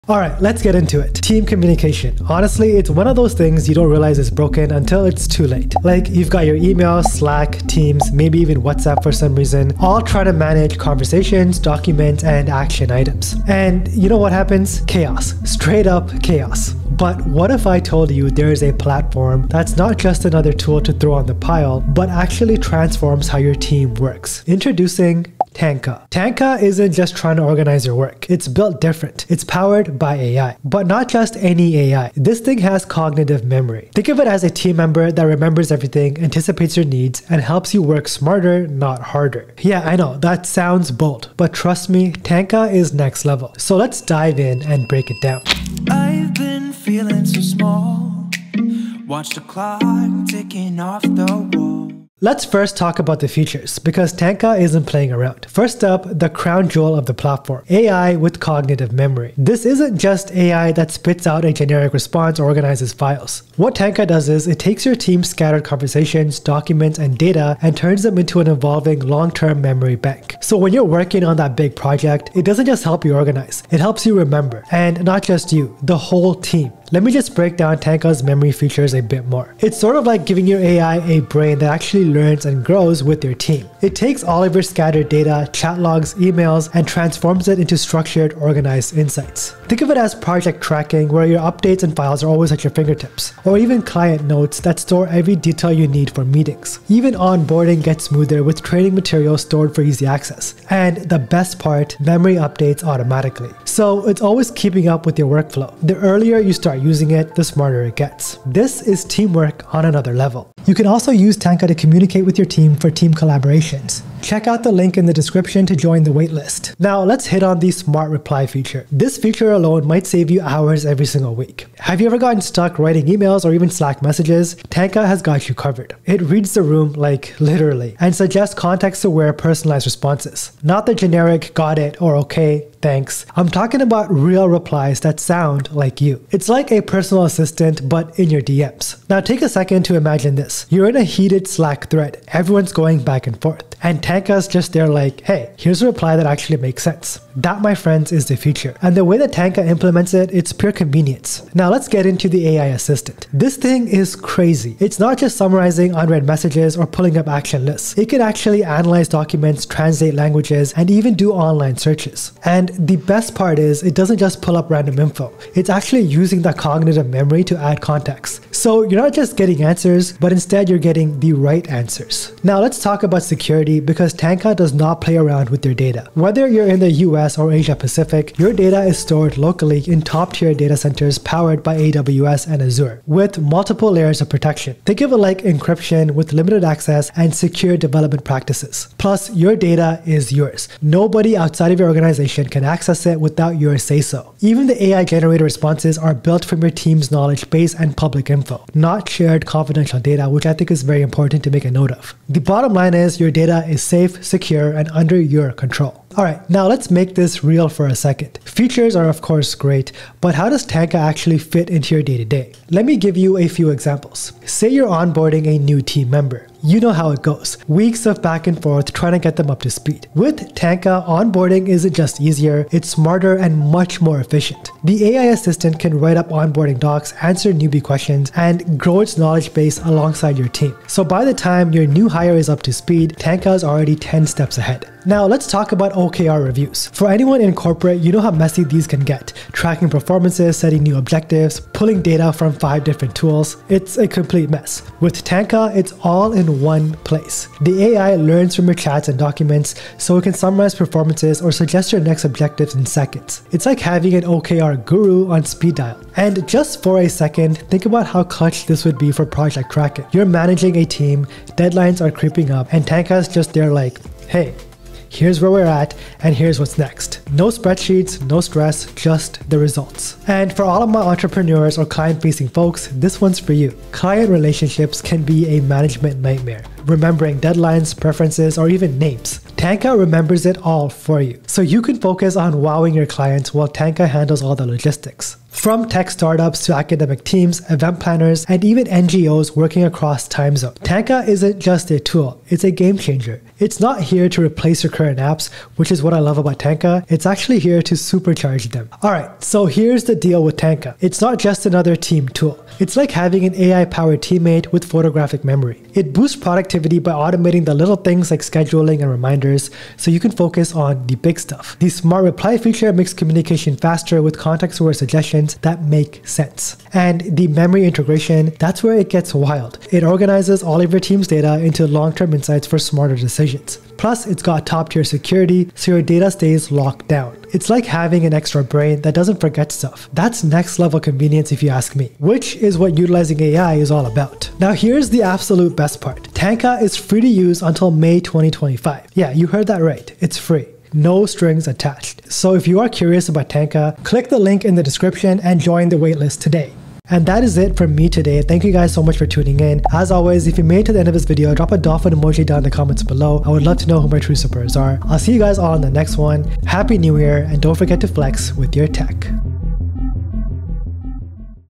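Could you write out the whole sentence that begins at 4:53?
It's not here to replace your current apps, which is what I love about Tanka.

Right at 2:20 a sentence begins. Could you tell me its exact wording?
You're in a heated Slack thread.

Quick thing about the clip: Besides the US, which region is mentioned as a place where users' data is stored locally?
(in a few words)
Asia Pacific.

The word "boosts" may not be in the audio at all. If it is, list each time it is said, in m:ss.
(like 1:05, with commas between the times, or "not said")
5:06.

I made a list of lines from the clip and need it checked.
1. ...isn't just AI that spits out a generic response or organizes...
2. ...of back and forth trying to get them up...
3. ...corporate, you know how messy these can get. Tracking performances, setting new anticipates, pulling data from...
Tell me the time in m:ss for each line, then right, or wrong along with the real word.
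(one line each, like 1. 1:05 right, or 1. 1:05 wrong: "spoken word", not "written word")
1. 0:59 right
2. 3:38 right
3. 3:57 wrong: "objectives", not "anticipates".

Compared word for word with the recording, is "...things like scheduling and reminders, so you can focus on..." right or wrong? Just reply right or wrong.
right.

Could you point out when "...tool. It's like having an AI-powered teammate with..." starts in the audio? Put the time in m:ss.
5:02.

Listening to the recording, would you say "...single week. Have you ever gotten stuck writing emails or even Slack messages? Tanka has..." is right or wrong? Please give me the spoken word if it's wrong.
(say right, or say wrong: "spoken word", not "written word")
right.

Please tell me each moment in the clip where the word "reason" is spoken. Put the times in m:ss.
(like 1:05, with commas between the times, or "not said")
0:09.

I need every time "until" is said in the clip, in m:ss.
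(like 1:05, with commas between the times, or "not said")
0:04, 5:37.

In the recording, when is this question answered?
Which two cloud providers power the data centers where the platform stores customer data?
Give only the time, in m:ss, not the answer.
3:01.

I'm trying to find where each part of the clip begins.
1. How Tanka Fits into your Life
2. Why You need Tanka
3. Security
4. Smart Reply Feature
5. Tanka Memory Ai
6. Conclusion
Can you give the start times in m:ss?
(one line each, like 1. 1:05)
1. 3:29
2. 4:58
3. 2:52
4. 2:00
5. 0:52
6. 5:35.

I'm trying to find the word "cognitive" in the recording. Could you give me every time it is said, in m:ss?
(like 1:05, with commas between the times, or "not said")
0:32, 0:58, 2:46.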